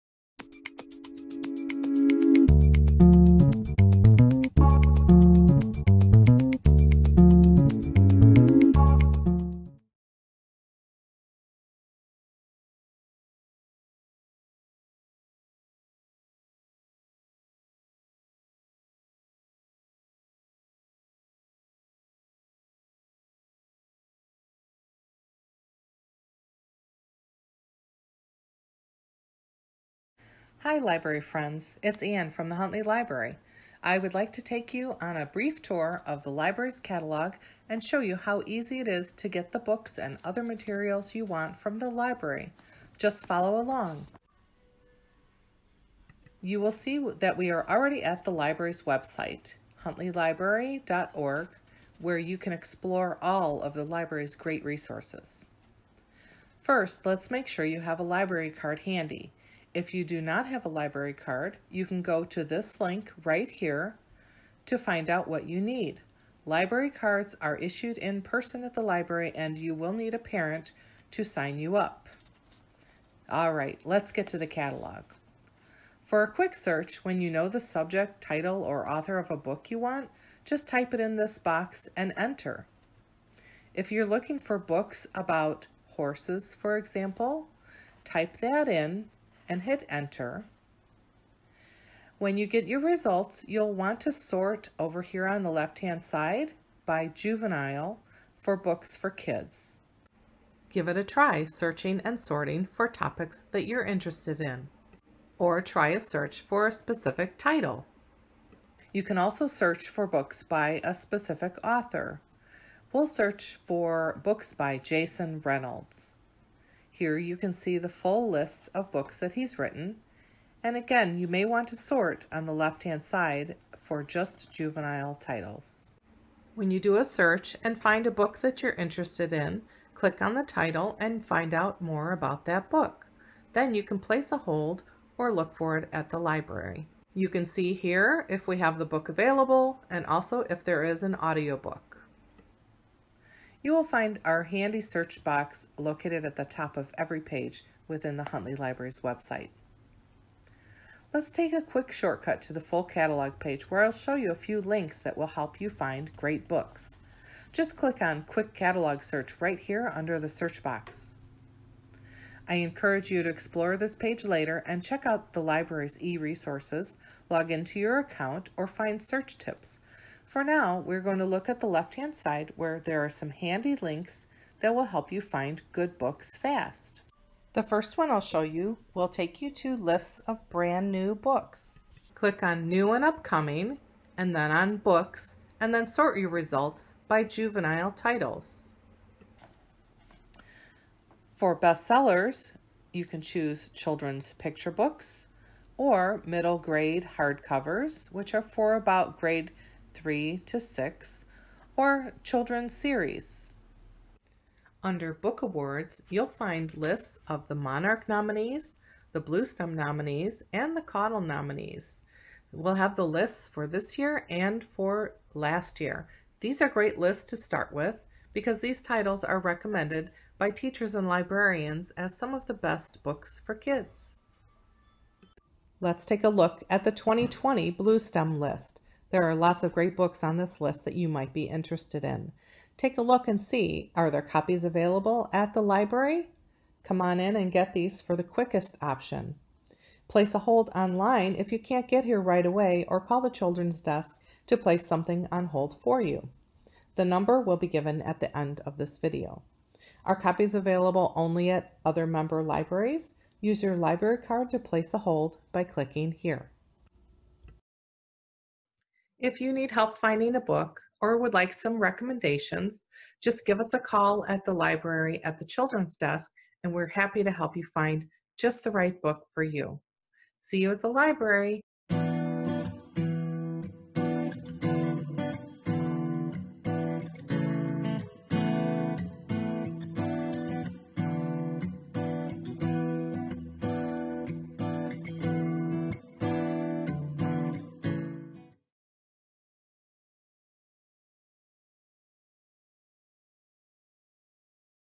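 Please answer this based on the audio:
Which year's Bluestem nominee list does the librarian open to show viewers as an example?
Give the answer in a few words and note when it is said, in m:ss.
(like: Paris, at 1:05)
2020, at 3:46.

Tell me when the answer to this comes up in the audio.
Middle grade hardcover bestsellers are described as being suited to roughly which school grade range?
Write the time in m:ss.
3:19.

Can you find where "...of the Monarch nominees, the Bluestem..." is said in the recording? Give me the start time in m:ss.
3:27.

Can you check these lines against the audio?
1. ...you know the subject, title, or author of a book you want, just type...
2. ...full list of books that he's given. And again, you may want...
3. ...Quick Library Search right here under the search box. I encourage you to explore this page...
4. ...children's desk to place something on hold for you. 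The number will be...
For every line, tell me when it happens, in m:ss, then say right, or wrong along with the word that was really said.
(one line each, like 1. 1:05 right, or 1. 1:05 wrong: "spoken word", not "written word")
1. 1:17 right
2. 1:57 wrong: "written", not "given"
3. 2:38 wrong: "Catalog", not "Library"
4. 4:03 right.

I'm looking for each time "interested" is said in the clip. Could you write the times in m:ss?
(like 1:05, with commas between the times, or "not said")
1:43, 2:08, 3:51.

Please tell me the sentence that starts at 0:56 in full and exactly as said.
First, let's make sure you have a library card handy.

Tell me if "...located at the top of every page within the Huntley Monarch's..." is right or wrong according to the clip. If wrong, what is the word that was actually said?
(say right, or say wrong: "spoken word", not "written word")
wrong: "Library", not "Monarch".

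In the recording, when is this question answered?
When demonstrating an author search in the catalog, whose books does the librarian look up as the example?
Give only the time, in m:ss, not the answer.
1:54.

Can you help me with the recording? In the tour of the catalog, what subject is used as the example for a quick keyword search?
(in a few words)
horses.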